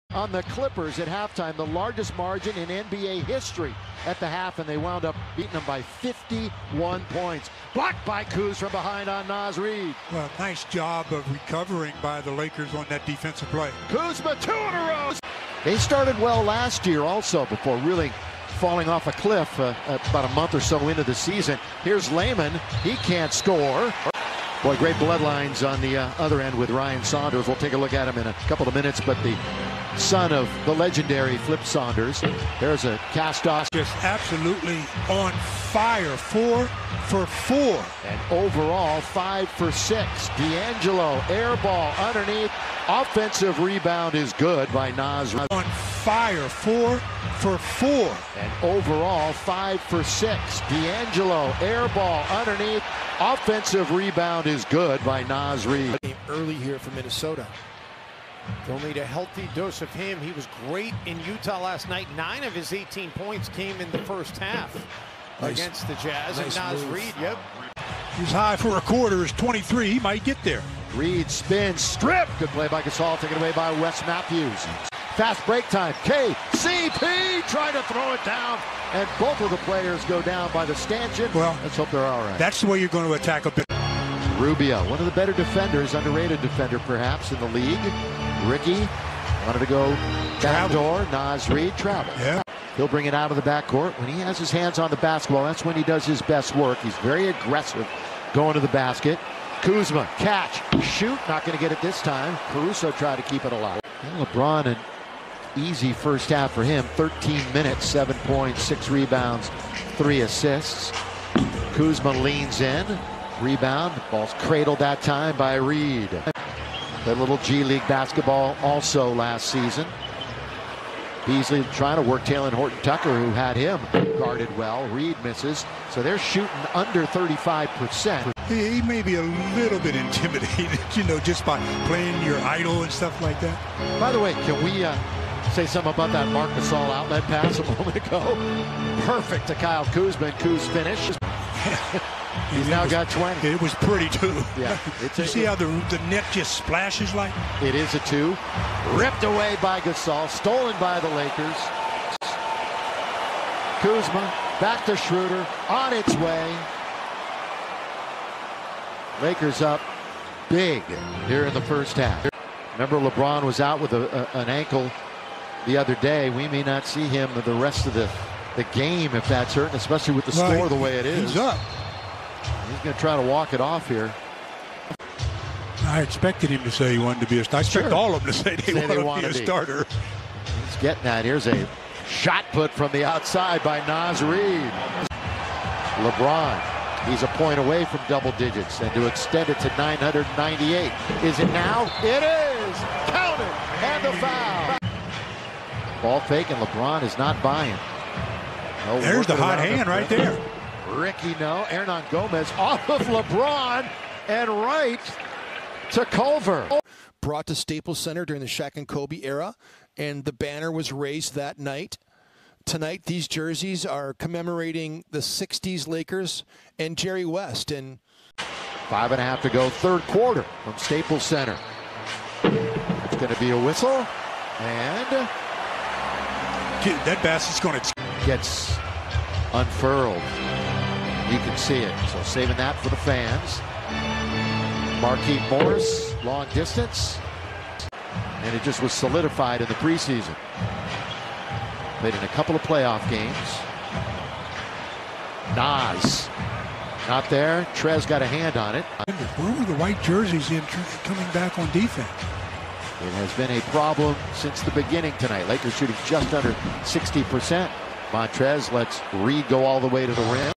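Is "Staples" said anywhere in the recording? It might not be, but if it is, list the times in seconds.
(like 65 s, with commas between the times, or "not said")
207 s, 220 s.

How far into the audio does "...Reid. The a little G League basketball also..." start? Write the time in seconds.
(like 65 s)
115 s.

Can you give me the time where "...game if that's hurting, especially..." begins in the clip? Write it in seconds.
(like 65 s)
168 s.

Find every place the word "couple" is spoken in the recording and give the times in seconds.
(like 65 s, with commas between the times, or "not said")
28 s, 242 s.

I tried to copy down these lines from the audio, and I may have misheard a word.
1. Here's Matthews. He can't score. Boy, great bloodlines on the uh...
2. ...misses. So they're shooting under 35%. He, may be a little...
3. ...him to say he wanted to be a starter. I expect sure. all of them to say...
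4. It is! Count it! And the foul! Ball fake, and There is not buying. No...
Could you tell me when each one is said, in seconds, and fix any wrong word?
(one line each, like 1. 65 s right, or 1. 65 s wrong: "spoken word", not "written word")
1. 21 s wrong: "Layman", not "Matthews"
2. 125 s right
3. 176 s right
4. 192 s wrong: "LeBron", not "There".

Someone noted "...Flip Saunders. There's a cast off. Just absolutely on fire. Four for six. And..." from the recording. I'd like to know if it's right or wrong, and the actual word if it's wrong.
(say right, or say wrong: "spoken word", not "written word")
wrong: "four", not "six".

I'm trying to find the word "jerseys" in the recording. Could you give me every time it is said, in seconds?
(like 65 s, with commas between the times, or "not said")
213 s, 250 s.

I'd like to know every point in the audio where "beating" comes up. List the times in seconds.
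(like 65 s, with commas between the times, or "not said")
5 s.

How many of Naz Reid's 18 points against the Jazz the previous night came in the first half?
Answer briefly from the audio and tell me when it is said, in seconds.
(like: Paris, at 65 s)
9, at 62 s.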